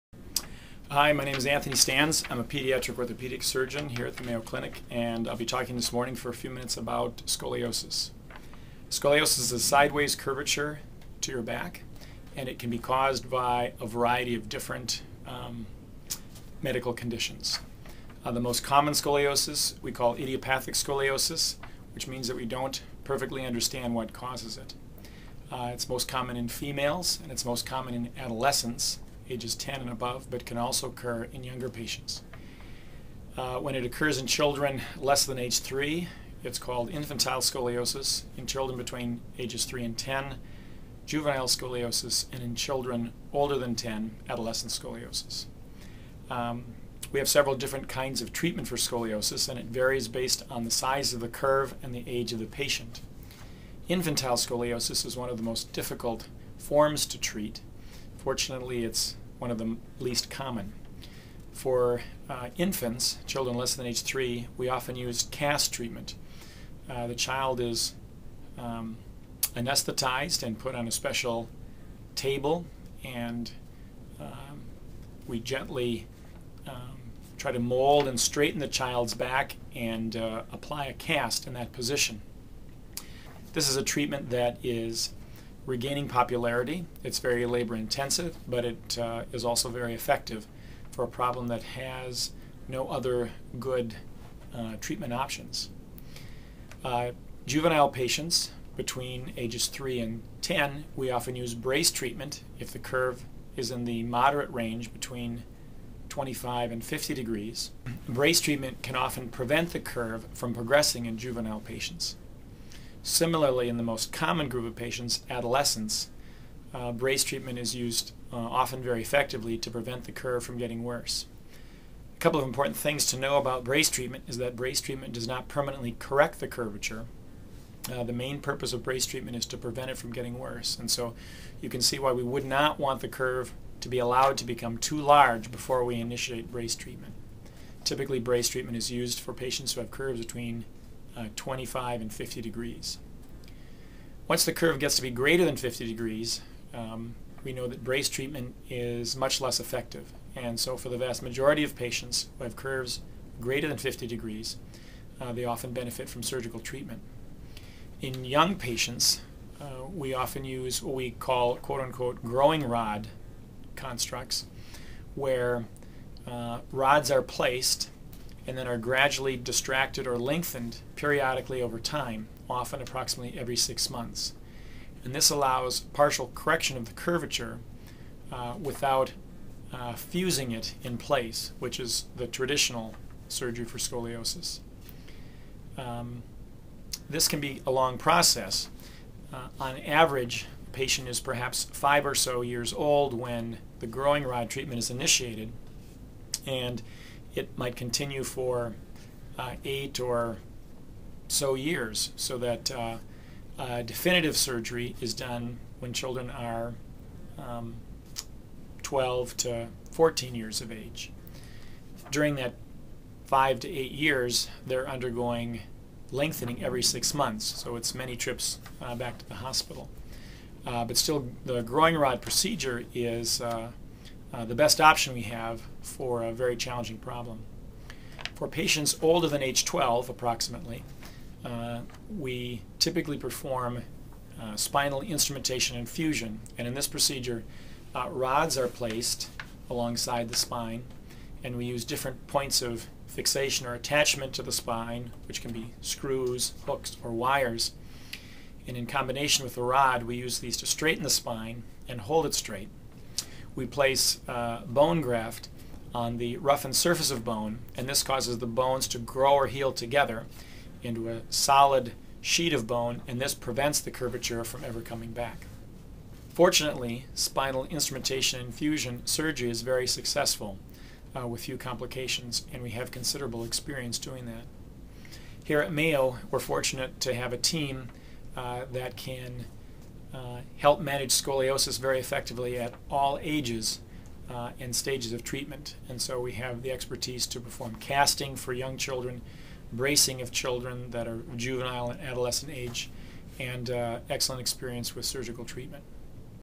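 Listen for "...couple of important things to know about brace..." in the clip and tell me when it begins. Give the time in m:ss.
2:02.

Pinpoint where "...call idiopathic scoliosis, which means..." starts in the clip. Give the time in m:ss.
0:19.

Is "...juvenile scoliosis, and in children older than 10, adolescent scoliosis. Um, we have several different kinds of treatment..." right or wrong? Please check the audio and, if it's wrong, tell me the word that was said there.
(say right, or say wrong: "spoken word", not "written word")
right.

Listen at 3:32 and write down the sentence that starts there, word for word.
During that five to eight years, they're undergoing lengthening every six months, so it's many trips uh, back to the hospital.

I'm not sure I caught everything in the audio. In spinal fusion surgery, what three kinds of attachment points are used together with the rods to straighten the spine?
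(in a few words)
screws, hooks, or wires.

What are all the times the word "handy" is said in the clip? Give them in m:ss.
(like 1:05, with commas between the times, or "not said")
not said.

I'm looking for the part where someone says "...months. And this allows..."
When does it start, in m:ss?
2:53.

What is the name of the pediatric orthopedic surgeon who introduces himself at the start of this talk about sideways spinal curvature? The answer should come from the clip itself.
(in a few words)
Anthony Stans.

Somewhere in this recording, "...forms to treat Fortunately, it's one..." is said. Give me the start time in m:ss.
0:56.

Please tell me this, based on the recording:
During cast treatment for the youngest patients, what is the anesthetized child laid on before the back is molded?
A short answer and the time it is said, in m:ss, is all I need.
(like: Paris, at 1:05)
a special table, at 1:10.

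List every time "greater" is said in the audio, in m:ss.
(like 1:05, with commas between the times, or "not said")
2:25, 2:33.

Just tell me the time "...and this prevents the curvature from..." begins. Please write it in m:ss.
4:23.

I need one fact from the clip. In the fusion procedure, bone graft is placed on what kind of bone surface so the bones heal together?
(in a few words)
roughened surface.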